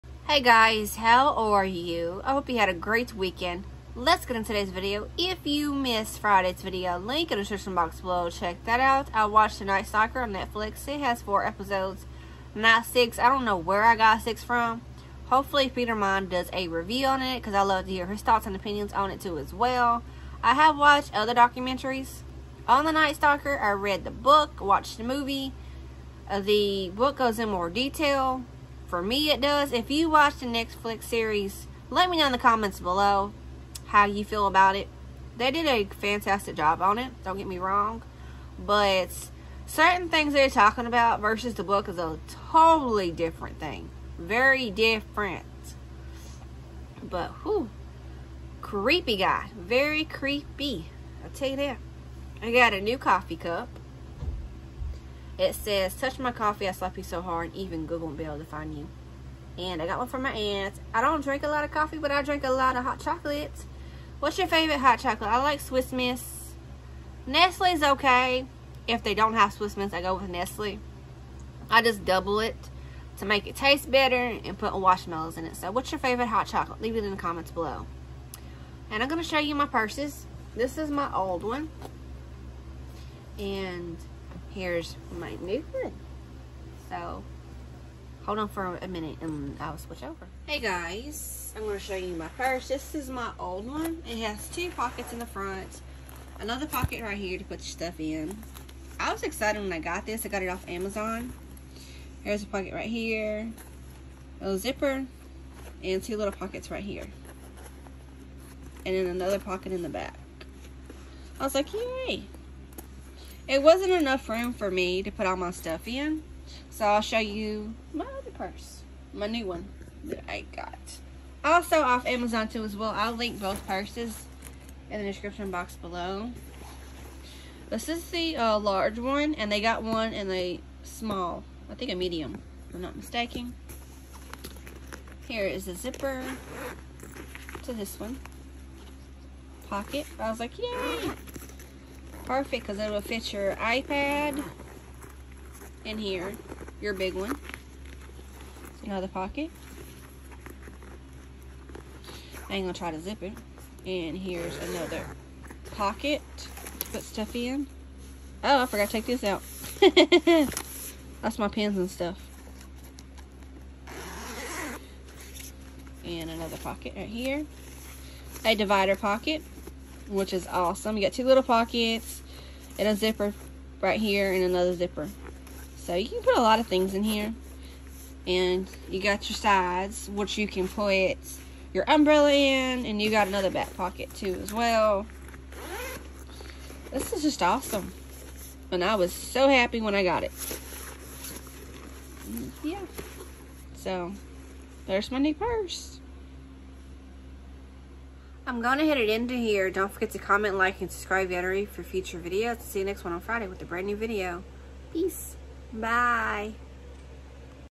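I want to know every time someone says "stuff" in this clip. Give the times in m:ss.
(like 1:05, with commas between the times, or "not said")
1:37, 1:55, 2:37, 2:41.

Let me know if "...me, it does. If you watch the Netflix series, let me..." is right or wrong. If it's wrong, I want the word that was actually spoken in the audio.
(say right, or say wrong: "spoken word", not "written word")
right.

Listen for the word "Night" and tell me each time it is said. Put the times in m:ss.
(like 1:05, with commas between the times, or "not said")
0:09, 0:22.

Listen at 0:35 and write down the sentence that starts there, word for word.
They did a fantastic job on it, don't get me wrong.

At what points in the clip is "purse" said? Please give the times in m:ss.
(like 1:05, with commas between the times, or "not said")
1:19, 1:32, 1:58, 2:03, 3:15.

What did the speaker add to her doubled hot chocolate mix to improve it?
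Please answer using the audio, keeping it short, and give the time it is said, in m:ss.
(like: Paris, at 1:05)
Marshmallows, at 1:14.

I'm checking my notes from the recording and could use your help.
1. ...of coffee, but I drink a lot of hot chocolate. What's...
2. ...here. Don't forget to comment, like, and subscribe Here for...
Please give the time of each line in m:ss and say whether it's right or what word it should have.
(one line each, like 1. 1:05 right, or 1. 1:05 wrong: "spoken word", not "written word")
1. 1:01 right
2. 3:19 wrong: "Yattery", not "Here".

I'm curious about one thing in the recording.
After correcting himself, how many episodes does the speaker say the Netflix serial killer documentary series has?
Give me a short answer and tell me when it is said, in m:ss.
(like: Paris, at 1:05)
4, at 0:11.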